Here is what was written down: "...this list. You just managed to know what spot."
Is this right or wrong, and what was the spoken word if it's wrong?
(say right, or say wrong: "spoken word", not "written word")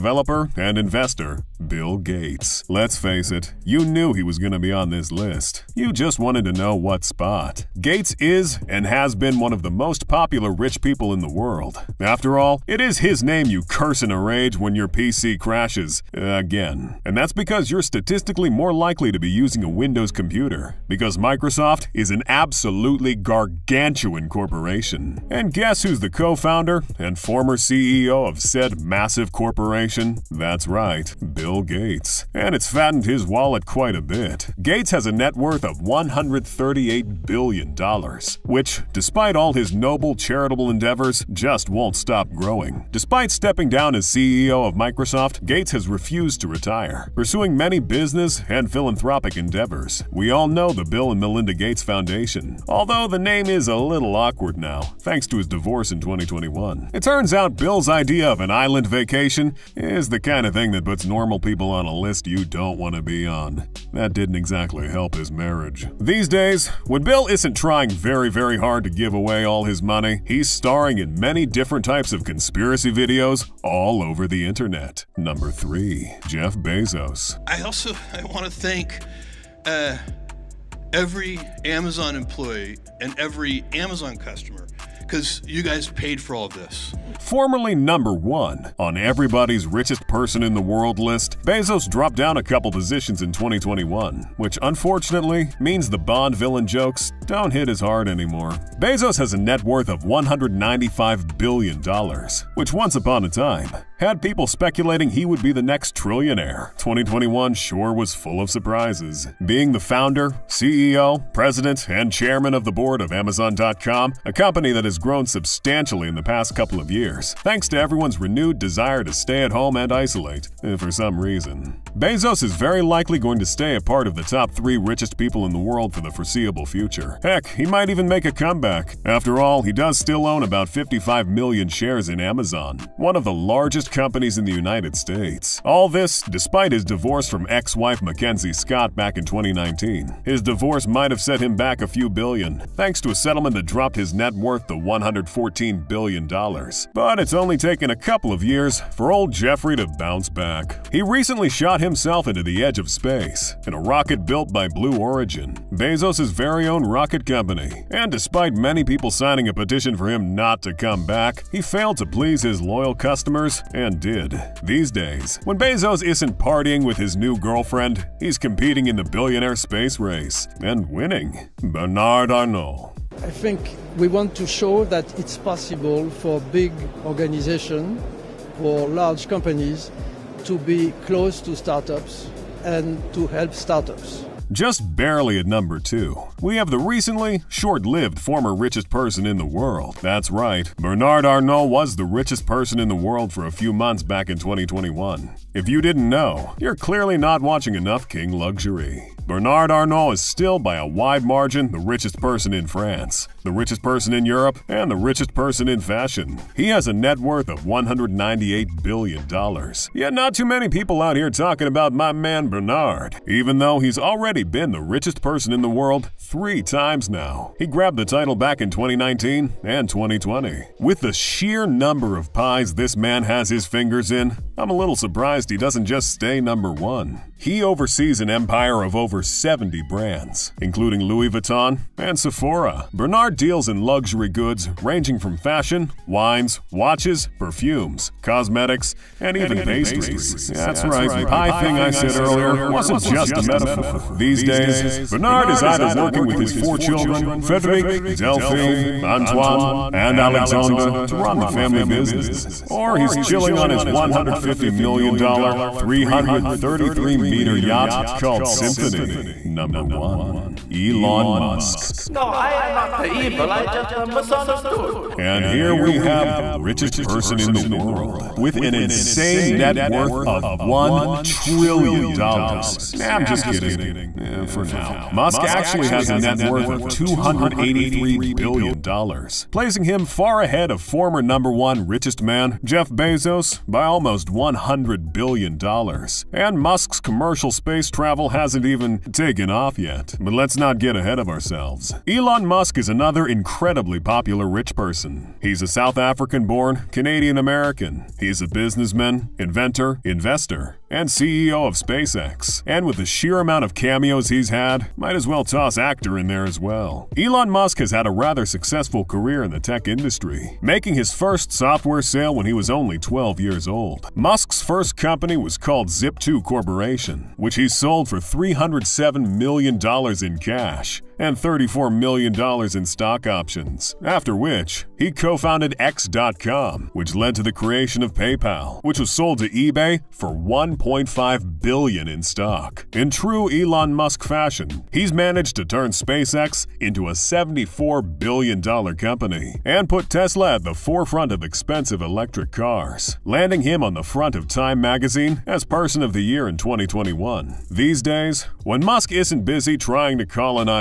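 wrong: "wanted", not "managed".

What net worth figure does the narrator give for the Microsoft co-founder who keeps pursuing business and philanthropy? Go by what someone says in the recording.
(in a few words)
$138 billion.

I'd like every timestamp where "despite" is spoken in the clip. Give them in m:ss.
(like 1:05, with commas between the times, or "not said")
0:38, 0:42, 2:16, 2:38.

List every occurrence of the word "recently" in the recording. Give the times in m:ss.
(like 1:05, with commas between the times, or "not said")
2:31, 3:06.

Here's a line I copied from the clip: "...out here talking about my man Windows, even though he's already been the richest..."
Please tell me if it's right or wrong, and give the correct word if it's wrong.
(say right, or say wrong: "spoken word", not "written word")
wrong: "Bernard", not "Windows".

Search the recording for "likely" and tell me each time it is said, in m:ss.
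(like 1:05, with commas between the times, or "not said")
0:18, 2:02.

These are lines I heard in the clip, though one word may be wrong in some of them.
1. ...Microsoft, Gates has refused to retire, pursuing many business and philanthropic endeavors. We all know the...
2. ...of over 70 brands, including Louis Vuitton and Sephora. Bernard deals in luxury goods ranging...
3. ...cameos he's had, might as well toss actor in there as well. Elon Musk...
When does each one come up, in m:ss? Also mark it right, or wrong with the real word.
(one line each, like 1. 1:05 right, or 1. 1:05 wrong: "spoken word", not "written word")
1. 0:44 right
2. 3:48 right
3. 5:04 right.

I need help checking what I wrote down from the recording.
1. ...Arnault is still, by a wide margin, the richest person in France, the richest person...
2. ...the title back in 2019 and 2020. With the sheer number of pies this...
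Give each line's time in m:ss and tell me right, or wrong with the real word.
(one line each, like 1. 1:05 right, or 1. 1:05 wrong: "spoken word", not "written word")
1. 3:19 right
2. 3:37 right.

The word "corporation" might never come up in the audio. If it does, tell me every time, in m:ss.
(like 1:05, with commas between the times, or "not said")
0:24, 0:29, 5:16.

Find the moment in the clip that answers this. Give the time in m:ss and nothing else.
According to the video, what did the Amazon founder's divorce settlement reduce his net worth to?
2:24.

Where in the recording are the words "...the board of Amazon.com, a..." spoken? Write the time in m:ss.
1:52.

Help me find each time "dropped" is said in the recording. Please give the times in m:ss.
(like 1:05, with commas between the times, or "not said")
1:31, 2:23.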